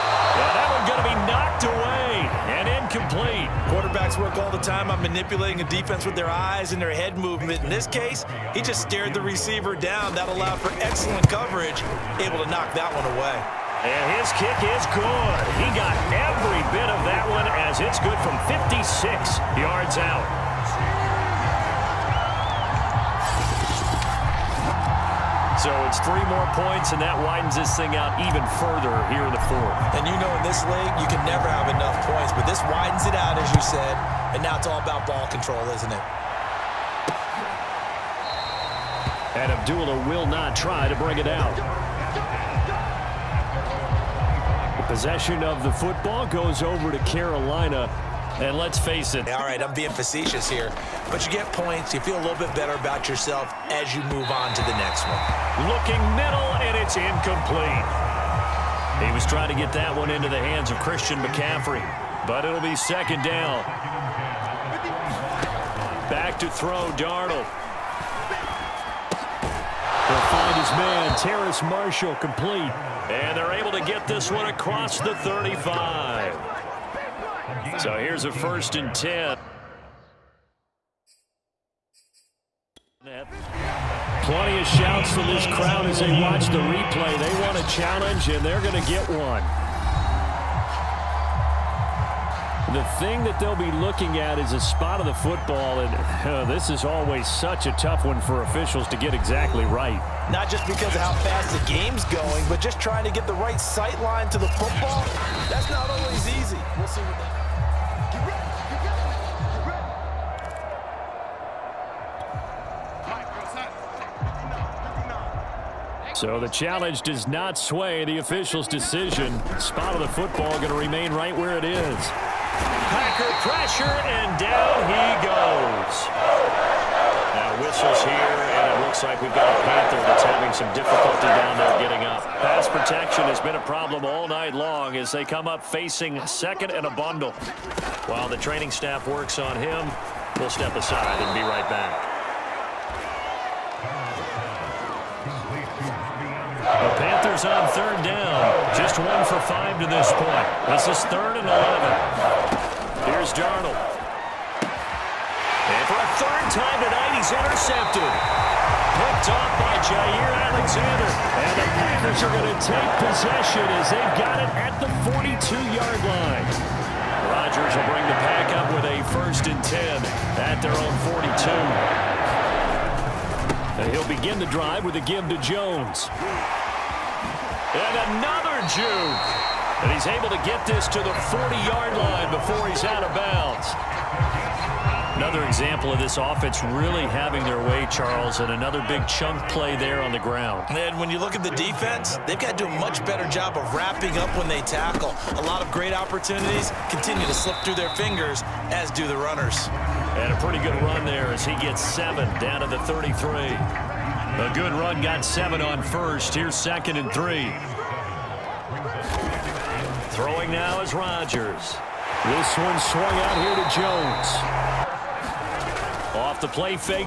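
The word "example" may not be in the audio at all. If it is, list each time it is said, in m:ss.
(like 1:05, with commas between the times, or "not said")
3:05.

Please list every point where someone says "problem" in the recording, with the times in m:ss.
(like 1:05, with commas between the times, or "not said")
2:13.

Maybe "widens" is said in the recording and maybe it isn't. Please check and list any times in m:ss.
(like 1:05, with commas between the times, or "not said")
0:27, 0:32.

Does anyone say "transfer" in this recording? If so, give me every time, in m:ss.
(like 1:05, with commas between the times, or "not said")
not said.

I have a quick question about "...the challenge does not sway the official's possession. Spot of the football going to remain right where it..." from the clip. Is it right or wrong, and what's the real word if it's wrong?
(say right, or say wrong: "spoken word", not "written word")
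wrong: "decision", not "possession".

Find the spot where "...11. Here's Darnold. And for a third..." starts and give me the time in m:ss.
2:31.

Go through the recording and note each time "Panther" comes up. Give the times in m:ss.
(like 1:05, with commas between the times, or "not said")
2:09, 2:26.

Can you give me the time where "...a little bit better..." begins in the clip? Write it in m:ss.
0:52.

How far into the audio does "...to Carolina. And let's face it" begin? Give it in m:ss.
0:46.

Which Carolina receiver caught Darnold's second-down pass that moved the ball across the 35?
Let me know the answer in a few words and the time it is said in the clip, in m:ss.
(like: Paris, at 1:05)
Terrace Marshall, at 1:11.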